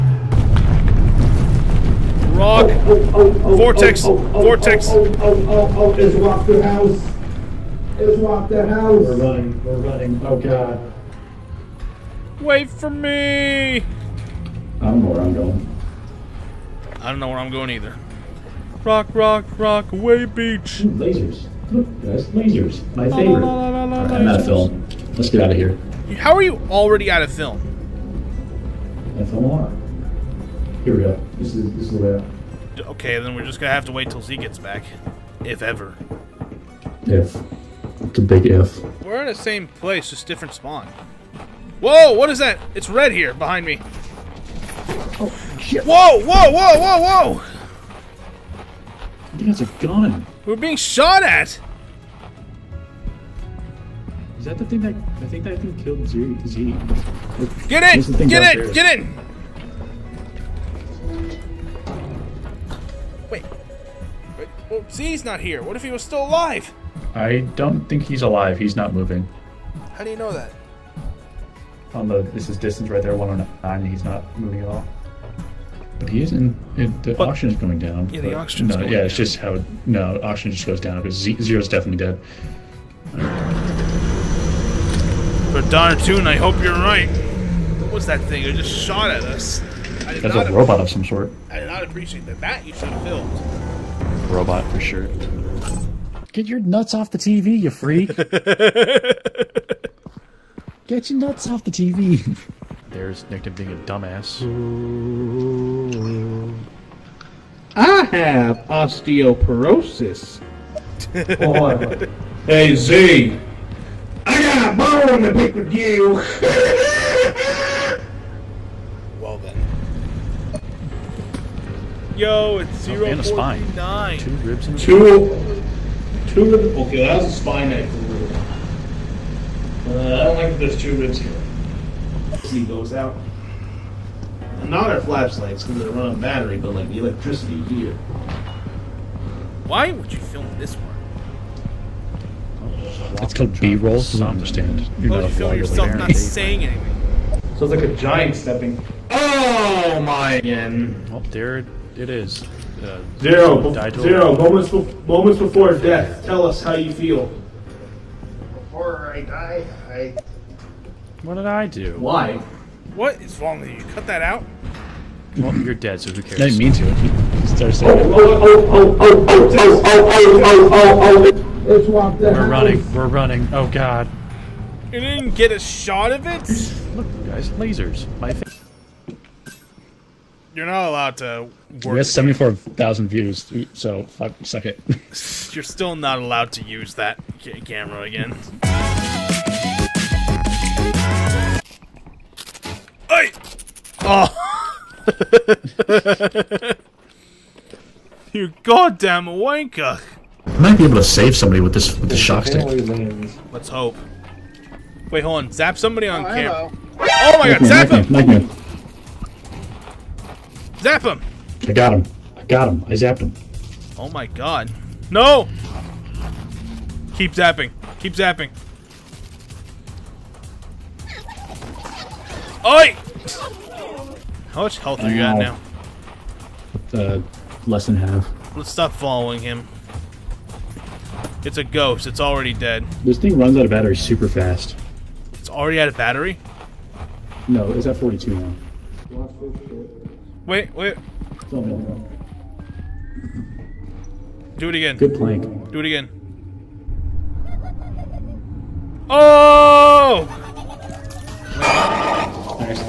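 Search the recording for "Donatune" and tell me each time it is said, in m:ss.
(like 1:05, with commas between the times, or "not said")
1:25.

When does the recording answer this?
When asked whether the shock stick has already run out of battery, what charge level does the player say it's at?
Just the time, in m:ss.
3:57.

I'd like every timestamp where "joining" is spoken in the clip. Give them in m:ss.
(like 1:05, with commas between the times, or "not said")
not said.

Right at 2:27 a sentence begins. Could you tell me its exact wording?
So it's like a giant stepping.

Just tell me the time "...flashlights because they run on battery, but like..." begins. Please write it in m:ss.
2:15.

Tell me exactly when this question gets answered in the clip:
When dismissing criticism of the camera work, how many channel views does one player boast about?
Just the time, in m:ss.
3:02.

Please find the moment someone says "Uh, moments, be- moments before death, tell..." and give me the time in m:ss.
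2:32.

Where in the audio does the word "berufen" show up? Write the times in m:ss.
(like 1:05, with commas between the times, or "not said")
not said.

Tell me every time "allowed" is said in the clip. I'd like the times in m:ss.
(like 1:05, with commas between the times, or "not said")
3:00, 3:06.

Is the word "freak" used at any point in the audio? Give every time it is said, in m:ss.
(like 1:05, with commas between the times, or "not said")
1:37.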